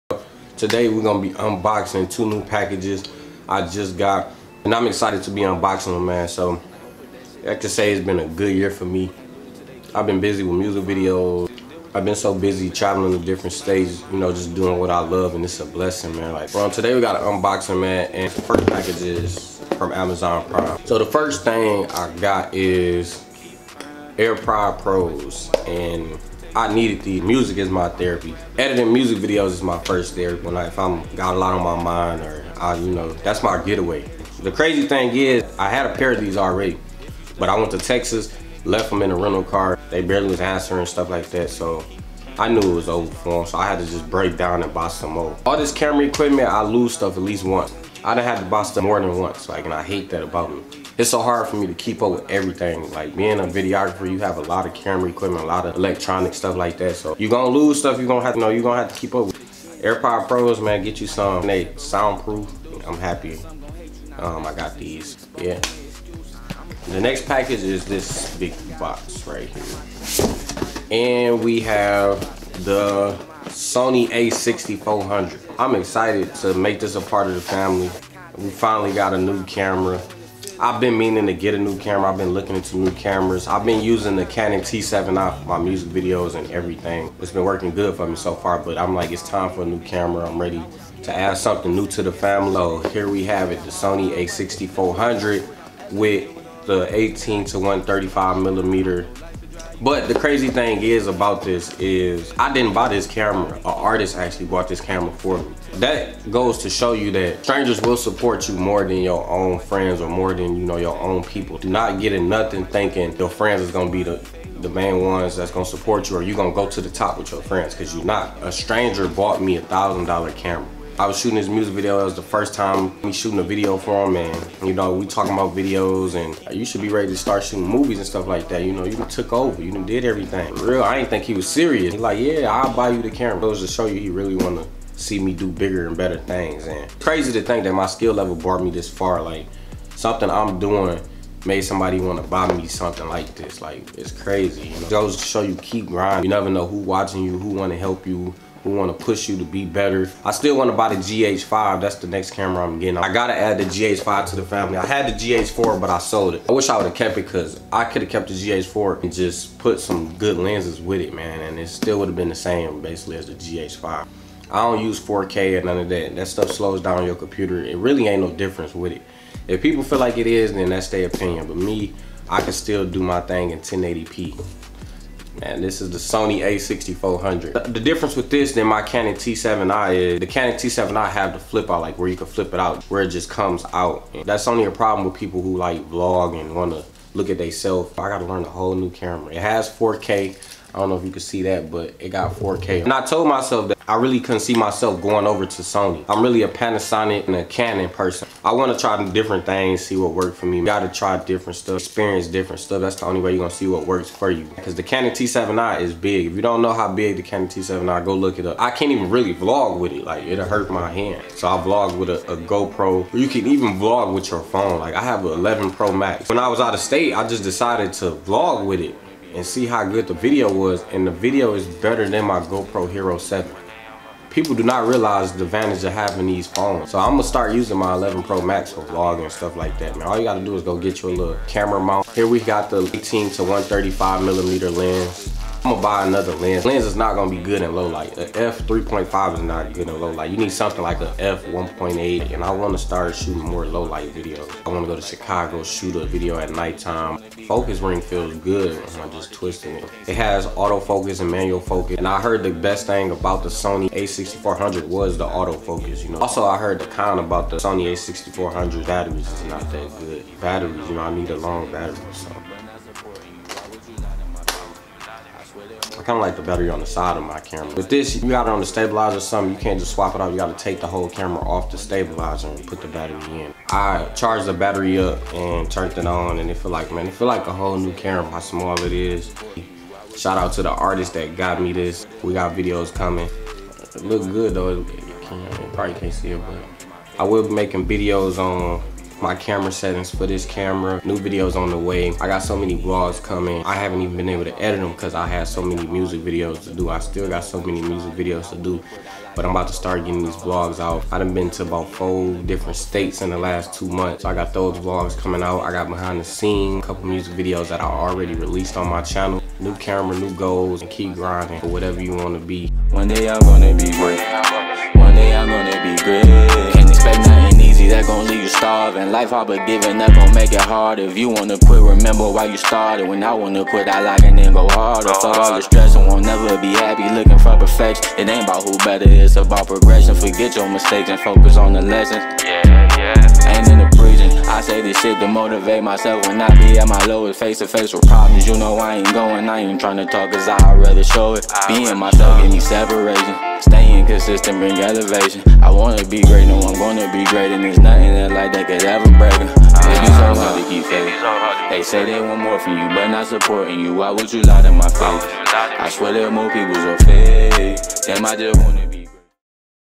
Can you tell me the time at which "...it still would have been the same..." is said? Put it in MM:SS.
02:41.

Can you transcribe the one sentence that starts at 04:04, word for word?
I wanna go to Chicago, shoot a video at nighttime.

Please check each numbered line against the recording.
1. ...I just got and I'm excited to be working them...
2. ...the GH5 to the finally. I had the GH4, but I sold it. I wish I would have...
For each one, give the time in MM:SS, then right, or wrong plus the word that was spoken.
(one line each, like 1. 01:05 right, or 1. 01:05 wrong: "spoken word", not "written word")
1. 00:03 wrong: "unboxing", not "working"
2. 02:33 wrong: "family", not "finally".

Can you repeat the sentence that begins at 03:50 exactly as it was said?
All you gotta do is go get you a little camera mount.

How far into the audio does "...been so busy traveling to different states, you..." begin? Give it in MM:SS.
00:12.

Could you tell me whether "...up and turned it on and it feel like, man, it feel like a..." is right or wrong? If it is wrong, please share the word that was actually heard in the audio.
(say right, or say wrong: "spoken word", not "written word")
right.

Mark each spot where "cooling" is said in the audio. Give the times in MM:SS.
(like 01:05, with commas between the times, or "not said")
not said.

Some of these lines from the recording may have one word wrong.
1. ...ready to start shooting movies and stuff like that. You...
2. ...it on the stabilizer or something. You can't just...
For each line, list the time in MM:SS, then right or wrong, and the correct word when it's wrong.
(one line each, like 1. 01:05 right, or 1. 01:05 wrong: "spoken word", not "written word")
1. 02:06 right
2. 04:28 right.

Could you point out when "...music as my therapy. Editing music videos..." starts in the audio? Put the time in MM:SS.
00:27.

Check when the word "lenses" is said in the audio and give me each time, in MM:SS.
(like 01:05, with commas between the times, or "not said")
02:40.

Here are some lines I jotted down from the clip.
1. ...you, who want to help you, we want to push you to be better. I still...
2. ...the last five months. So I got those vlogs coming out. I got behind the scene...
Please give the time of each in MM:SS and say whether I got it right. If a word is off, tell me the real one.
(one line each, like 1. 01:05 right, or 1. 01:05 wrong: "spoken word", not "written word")
1. 02:27 right
2. 05:03 wrong: "two", not "five".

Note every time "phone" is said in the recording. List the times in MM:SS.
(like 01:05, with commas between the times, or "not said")
03:34, 03:46.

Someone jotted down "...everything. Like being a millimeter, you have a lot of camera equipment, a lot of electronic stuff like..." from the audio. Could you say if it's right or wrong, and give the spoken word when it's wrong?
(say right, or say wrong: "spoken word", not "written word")
wrong: "videographer", not "millimeter".